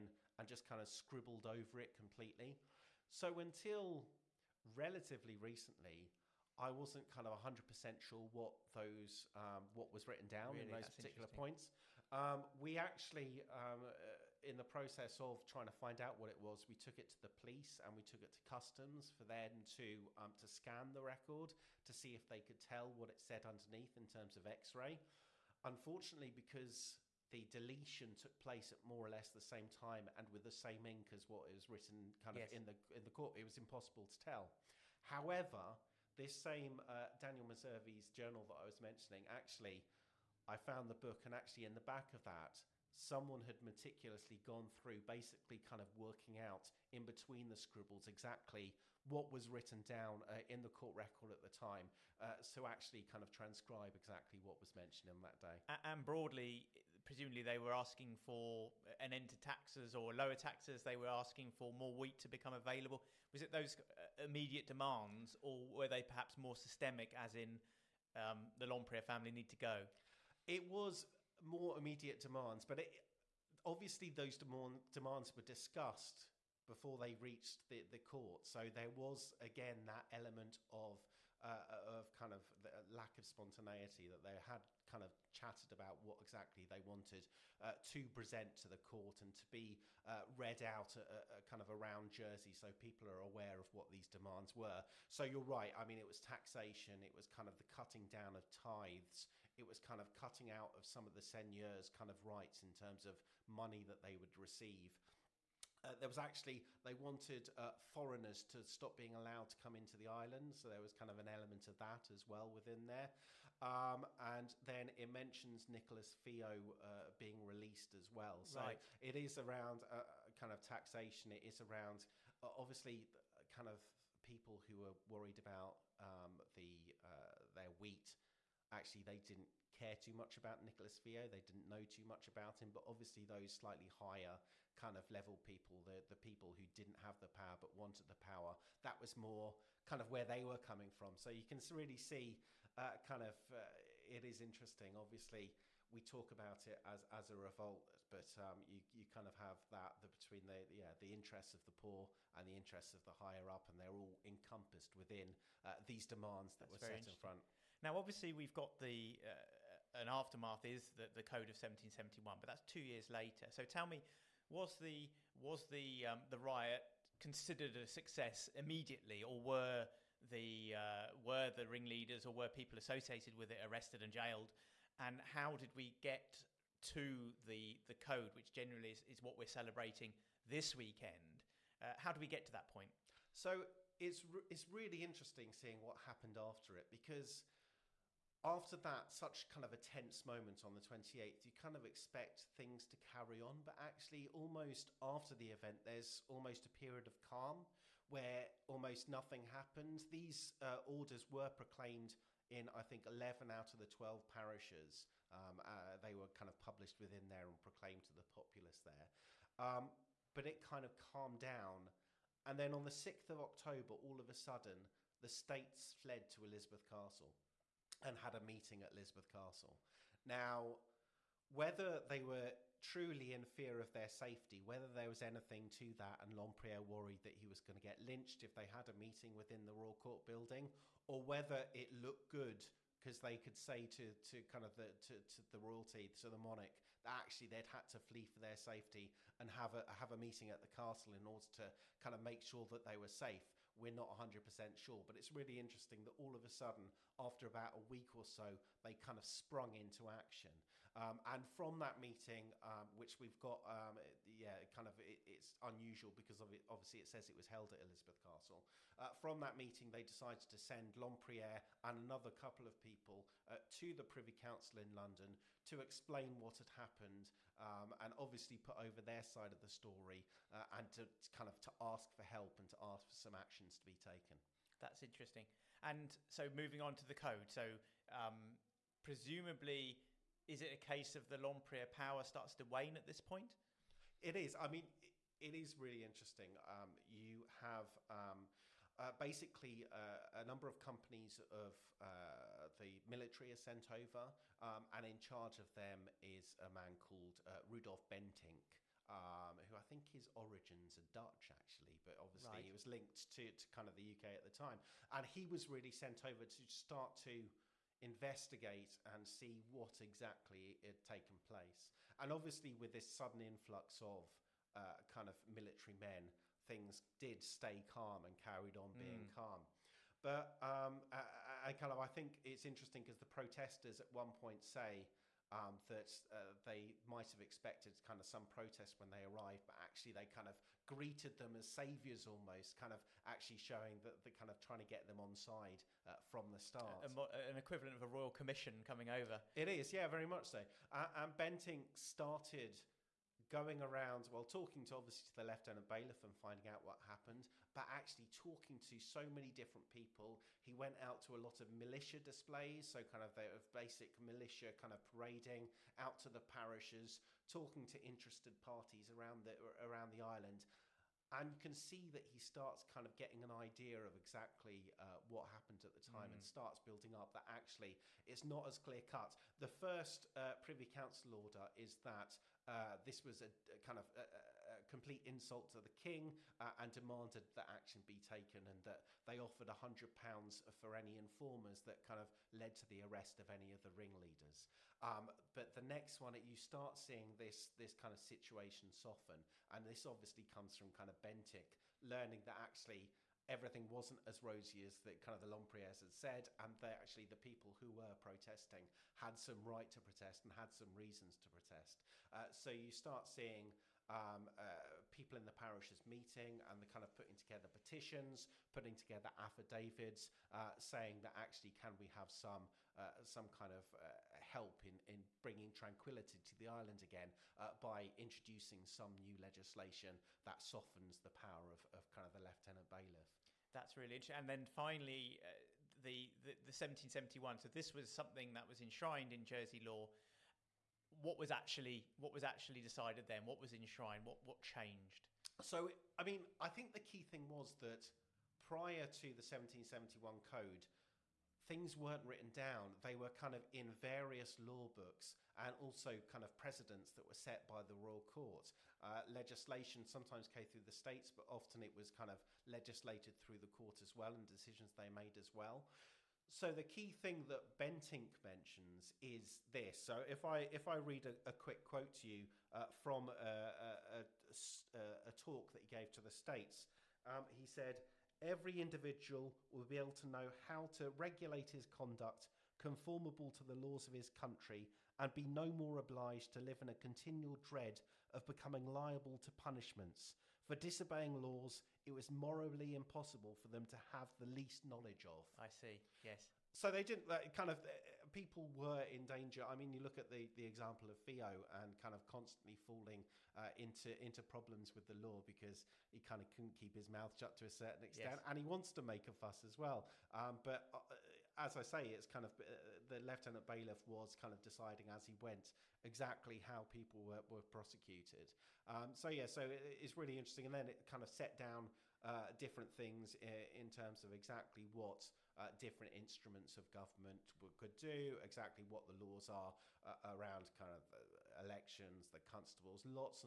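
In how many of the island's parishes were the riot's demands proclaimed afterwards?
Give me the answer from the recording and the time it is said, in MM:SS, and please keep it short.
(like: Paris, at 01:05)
11, at 03:23.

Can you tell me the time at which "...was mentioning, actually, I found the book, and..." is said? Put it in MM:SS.
00:38.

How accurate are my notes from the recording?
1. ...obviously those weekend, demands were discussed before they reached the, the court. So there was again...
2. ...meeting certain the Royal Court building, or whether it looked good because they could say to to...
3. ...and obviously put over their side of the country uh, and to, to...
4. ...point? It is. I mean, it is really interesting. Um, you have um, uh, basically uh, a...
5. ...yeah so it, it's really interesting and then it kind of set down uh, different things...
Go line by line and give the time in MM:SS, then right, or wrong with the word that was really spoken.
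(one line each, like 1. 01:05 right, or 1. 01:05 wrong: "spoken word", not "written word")
1. 01:13 wrong: "demand", not "weekend"
2. 03:48 wrong: "within", not "certain"
3. 04:27 wrong: "story", not "country"
4. 04:43 right
5. 08:29 right.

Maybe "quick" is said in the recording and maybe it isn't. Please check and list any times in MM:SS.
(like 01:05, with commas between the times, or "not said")
07:41.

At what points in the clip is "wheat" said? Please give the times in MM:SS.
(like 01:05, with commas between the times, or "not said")
01:01, 02:07.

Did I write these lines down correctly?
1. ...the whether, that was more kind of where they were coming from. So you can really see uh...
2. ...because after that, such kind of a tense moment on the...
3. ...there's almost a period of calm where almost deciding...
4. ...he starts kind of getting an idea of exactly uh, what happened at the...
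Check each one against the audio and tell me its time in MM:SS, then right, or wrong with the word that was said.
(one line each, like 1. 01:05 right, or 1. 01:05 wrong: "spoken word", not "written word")
1. 02:18 wrong: "power", not "whether"
2. 03:06 right
3. 03:15 wrong: "nothing", not "deciding"
4. 06:02 right.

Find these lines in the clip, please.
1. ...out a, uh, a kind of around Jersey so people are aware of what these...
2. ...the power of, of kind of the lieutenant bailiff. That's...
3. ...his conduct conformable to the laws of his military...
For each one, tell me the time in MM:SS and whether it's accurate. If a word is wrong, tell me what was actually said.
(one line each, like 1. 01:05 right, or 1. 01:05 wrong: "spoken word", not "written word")
1. 01:30 right
2. 07:01 right
3. 07:51 wrong: "country", not "military".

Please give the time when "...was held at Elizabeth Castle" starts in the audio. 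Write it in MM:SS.
04:17.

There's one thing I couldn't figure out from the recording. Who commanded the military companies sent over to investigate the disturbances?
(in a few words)
Rudolf Bentinck.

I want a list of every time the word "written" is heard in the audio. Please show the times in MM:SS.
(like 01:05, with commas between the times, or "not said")
00:10, 00:31, 00:49, 07:22.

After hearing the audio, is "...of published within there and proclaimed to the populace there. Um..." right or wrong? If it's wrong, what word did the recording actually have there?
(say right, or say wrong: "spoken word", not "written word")
right.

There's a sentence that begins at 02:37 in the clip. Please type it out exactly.
Now, obviously, we've got the uh, an aftermath is the Code of 1771, but that's two years later.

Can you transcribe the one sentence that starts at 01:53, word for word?
Um, and then it mentions Nicholas Fiott uh, being released as well.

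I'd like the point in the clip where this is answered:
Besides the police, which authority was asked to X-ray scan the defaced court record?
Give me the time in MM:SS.
00:18.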